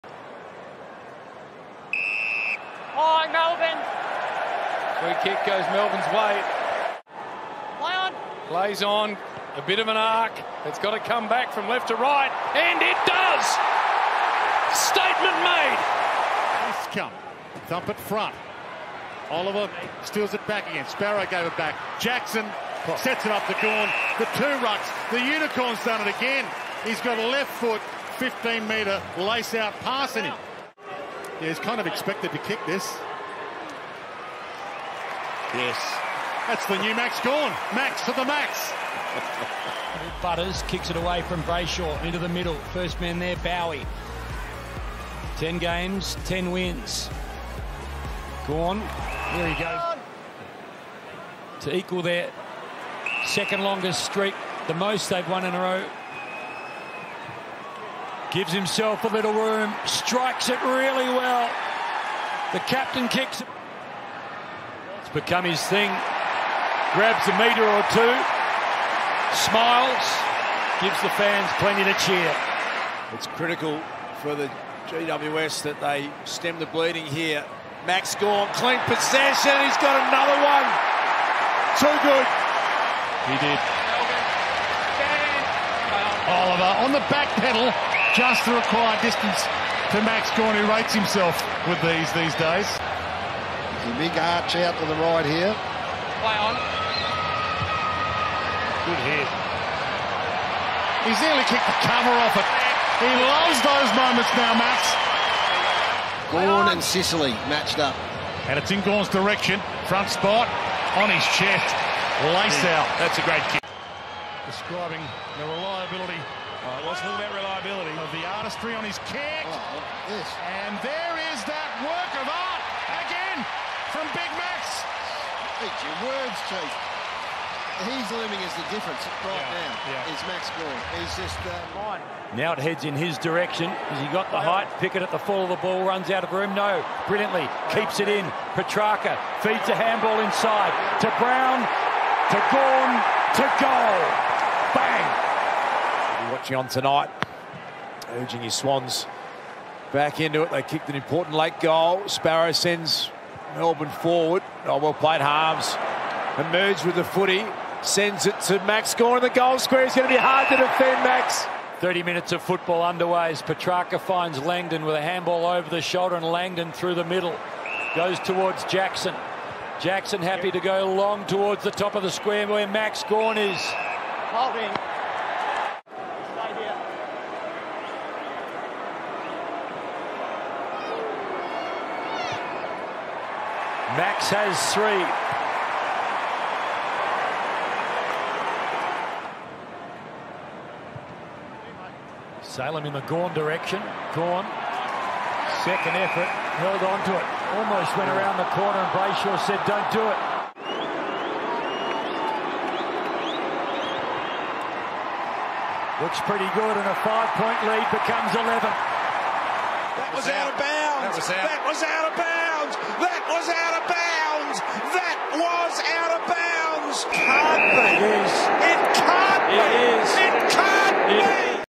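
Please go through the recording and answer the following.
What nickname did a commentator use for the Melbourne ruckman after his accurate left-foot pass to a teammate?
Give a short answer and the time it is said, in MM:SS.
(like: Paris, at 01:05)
The unicorn, at 00:25.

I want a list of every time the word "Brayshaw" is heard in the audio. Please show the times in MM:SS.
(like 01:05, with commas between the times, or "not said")
00:41, 03:18.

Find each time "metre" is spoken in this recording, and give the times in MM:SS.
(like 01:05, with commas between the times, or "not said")
00:28, 01:07.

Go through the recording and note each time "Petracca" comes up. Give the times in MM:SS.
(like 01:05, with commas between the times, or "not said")
02:18, 02:43.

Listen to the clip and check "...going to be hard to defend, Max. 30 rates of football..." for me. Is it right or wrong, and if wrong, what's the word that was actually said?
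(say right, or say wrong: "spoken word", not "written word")
wrong: "minutes", not "rates".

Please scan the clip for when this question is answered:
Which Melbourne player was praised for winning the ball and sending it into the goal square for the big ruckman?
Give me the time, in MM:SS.
02:35.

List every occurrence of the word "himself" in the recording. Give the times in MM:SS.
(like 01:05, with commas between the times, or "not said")
00:58, 01:30.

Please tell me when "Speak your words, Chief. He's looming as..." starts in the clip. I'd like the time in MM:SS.
02:05.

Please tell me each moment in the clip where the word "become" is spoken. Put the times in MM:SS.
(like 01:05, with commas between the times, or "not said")
01:05, 03:27.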